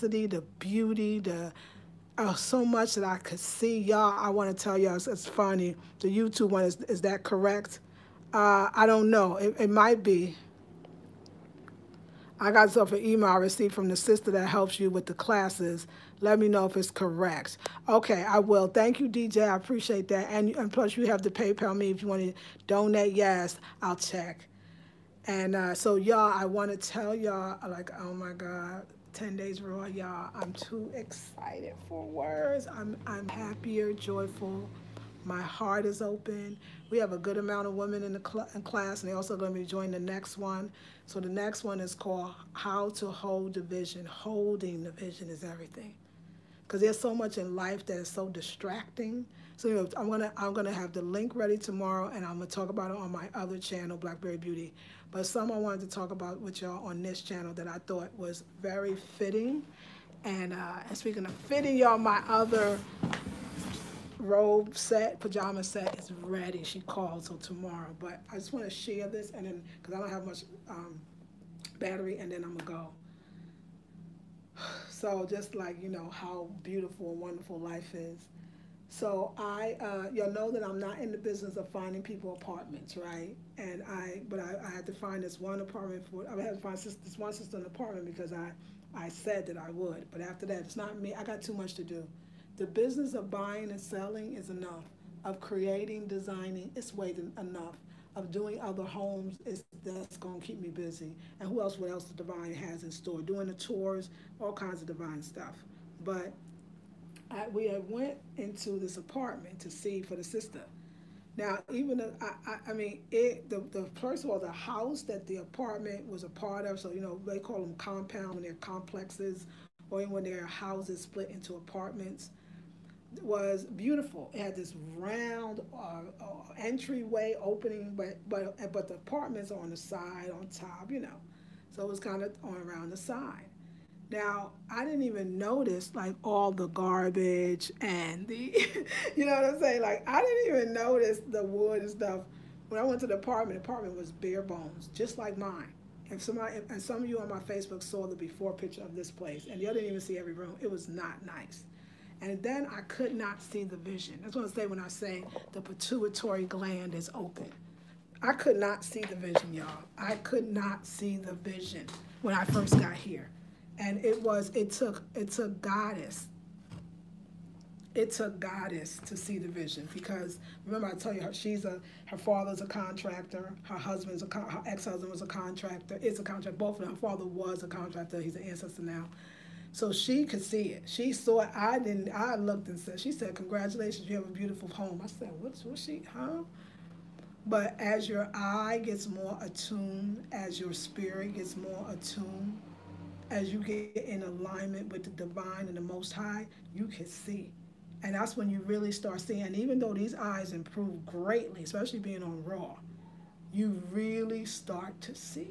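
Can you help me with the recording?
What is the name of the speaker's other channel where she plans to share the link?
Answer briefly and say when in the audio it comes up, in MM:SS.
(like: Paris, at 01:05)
Blackberry Beauty, at 00:53.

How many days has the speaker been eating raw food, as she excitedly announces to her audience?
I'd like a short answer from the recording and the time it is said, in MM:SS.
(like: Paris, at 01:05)
10, at 00:29.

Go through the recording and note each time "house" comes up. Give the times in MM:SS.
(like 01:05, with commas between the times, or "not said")
01:54, 02:00.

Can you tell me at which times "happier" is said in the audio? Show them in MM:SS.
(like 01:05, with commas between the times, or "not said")
00:33.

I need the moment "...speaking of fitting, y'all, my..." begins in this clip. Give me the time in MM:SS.
01:00.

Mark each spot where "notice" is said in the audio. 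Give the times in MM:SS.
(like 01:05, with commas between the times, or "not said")
02:15, 02:20.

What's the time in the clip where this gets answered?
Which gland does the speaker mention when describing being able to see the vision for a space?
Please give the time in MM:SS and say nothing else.
02:35.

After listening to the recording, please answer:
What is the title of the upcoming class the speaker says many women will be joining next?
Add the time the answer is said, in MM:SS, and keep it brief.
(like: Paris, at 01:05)
How to Hold the Vision, at 00:42.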